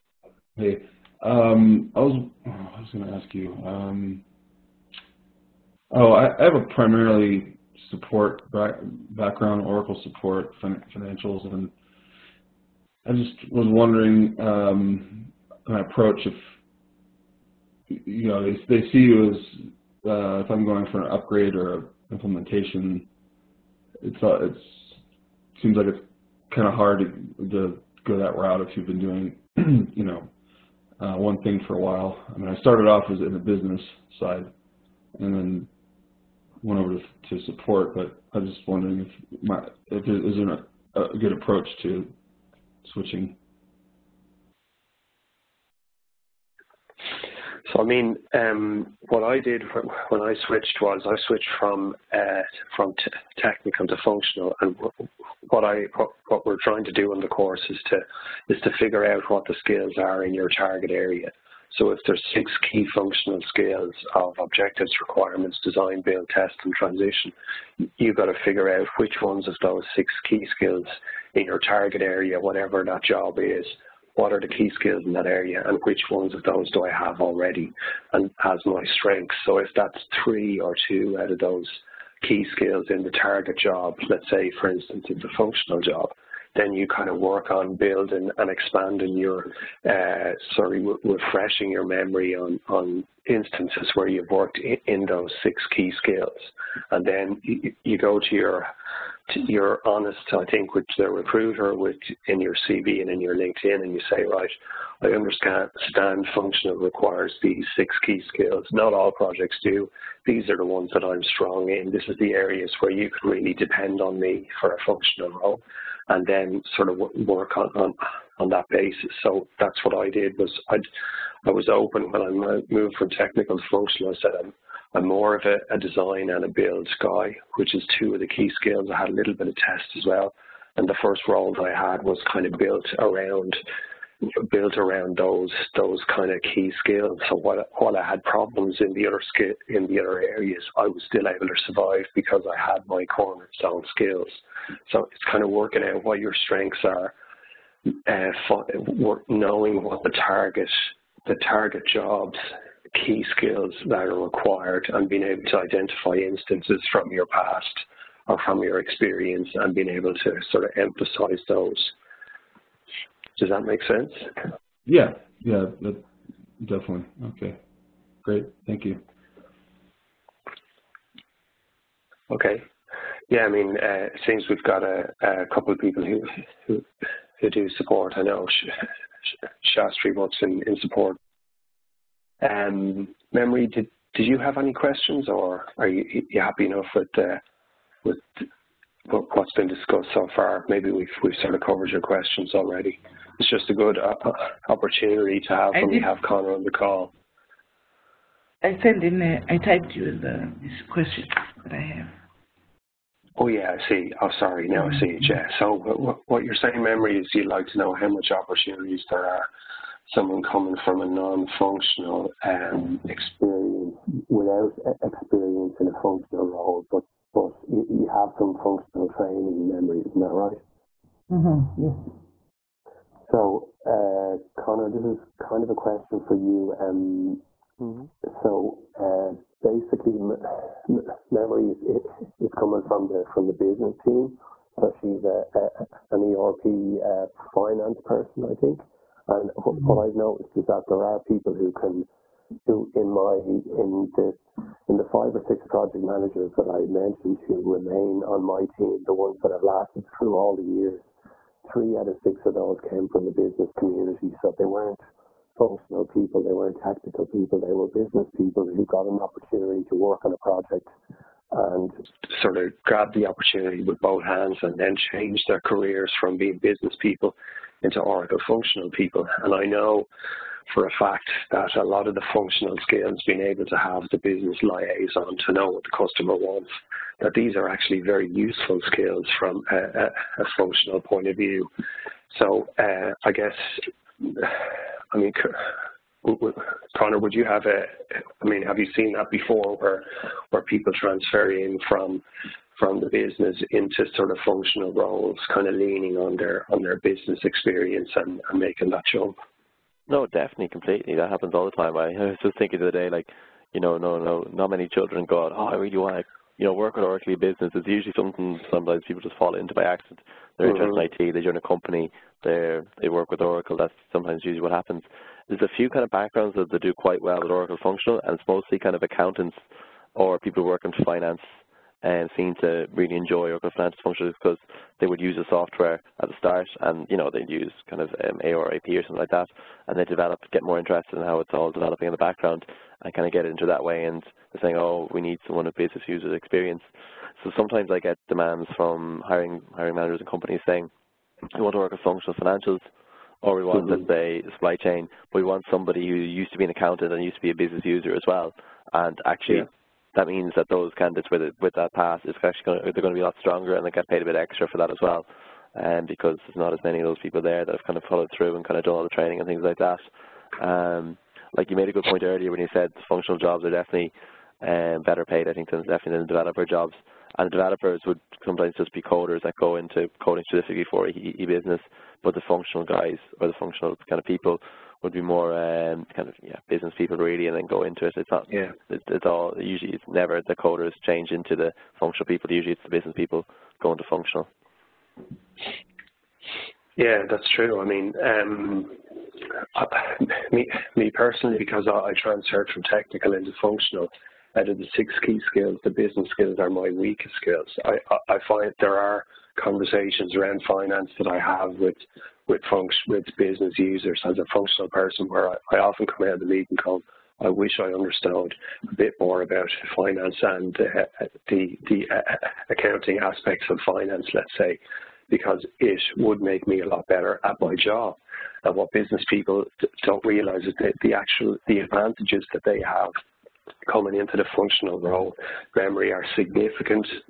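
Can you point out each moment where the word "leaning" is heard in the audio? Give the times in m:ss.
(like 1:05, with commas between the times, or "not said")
4:55.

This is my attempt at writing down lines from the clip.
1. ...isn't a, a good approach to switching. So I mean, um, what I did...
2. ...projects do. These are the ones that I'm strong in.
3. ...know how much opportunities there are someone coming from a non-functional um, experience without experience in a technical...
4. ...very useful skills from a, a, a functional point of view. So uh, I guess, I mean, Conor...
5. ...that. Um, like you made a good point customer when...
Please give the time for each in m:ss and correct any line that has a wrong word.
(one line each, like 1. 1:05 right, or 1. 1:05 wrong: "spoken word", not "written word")
1. 0:40 right
2. 1:49 right
3. 3:27 wrong: "functional", not "technical"
4. 4:38 right
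5. 5:59 wrong: "earlier", not "customer".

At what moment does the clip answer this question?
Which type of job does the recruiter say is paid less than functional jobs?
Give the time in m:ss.
6:06.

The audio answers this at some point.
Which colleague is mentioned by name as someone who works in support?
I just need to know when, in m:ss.
2:59.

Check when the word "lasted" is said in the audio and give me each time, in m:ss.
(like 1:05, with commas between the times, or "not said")
4:09.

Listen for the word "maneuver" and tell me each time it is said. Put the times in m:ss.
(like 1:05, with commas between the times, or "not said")
not said.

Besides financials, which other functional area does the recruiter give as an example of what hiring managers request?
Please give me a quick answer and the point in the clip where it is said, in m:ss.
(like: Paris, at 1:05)
Supply chain, at 5:44.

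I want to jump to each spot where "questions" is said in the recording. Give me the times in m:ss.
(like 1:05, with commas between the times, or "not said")
3:04, 3:12, 3:20, 3:45.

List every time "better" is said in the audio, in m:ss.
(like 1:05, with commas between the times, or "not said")
6:05, 6:57.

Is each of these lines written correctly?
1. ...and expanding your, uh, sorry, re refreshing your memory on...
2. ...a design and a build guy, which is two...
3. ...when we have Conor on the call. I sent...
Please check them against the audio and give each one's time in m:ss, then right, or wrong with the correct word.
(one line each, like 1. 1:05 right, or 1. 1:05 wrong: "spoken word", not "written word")
1. 1:28 right
2. 2:05 right
3. 3:15 right.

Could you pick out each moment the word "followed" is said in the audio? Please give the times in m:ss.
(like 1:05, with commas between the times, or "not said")
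5:58.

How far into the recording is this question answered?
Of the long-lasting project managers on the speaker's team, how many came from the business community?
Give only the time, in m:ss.
4:11.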